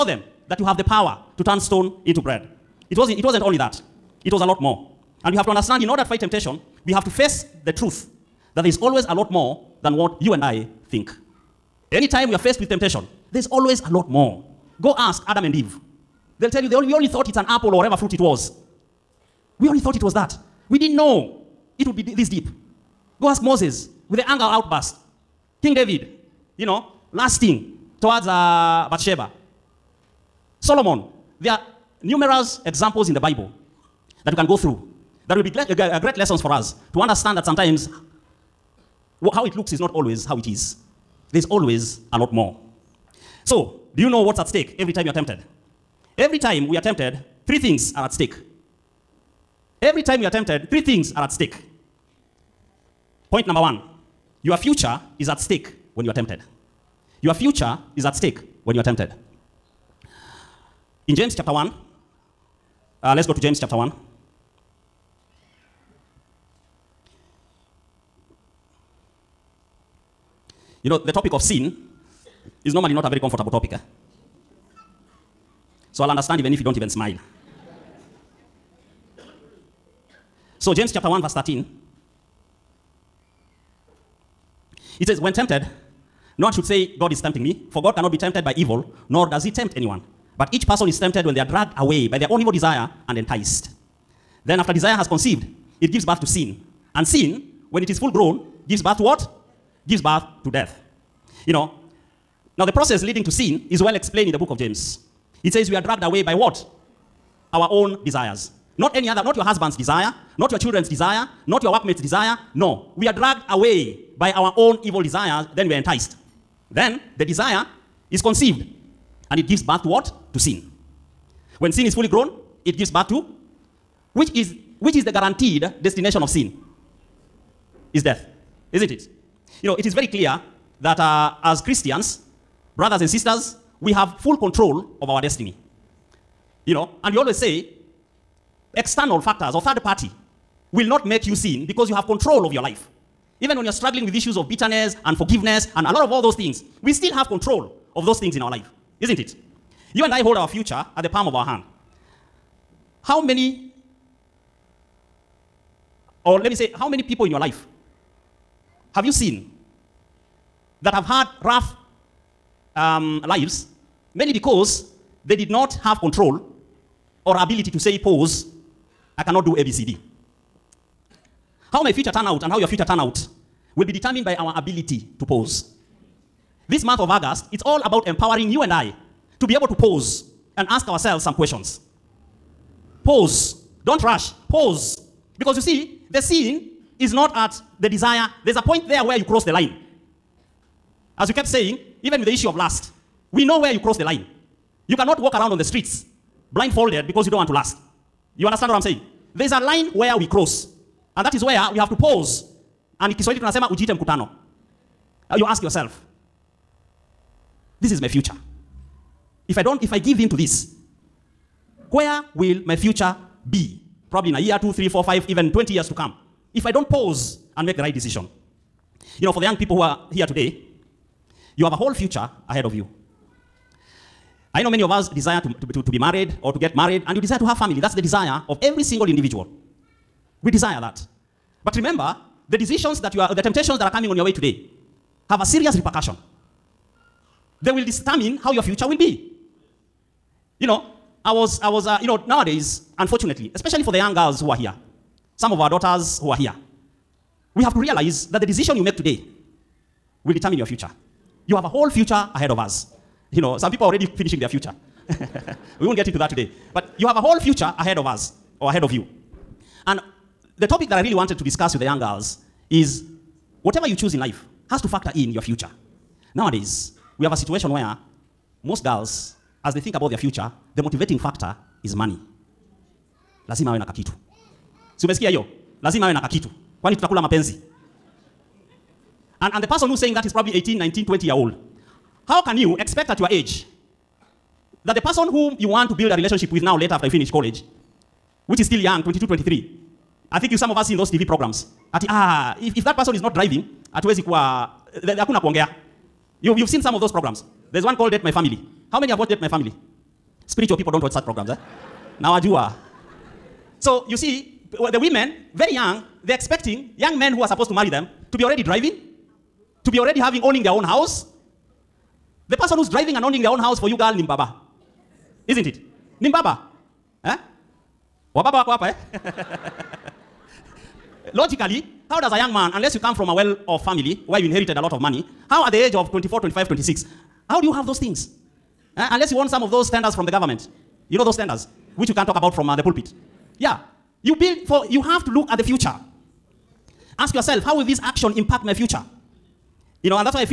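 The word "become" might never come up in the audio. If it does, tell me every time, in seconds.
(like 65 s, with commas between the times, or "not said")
not said.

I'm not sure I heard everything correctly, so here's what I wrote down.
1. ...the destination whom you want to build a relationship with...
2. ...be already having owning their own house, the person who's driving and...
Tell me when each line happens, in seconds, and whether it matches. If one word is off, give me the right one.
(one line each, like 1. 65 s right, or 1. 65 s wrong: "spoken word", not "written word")
1. 284 s wrong: "person", not "destination"
2. 309 s right.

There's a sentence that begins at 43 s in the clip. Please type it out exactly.
So, do you know what's at stake every time you are tempted?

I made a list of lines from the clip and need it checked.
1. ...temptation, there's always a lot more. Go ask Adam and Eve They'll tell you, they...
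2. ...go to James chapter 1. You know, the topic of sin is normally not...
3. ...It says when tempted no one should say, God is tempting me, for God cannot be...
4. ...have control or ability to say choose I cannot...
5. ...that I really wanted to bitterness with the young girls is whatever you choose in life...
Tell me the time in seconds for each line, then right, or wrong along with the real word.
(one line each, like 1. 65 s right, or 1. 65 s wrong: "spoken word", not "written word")
1. 12 s right
2. 63 s right
3. 84 s right
4. 165 s wrong: "pause", not "choose"
5. 260 s wrong: "discuss", not "bitterness".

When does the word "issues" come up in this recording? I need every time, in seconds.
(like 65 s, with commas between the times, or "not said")
144 s, 192 s.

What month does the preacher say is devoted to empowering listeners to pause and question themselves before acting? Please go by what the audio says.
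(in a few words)
August.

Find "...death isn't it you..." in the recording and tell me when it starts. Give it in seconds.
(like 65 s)
128 s.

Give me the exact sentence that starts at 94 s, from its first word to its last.
Then, after desire has conceived, it gives birth to sin.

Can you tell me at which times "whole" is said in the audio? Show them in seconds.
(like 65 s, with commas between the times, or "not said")
221 s, 251 s, 257 s.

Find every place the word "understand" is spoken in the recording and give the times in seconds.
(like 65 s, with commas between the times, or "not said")
5 s, 36 s, 76 s, 198 s.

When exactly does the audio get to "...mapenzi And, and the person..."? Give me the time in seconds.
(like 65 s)
277 s.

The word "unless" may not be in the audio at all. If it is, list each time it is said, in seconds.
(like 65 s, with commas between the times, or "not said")
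322 s, 329 s.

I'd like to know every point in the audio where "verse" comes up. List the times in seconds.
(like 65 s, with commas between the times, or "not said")
81 s.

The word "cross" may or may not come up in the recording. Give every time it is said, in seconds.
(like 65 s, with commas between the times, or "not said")
189 s, 193 s, 200 s.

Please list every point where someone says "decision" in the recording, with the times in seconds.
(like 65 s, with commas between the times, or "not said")
217 s, 232 s, 248 s.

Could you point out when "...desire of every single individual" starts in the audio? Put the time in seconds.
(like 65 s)
228 s.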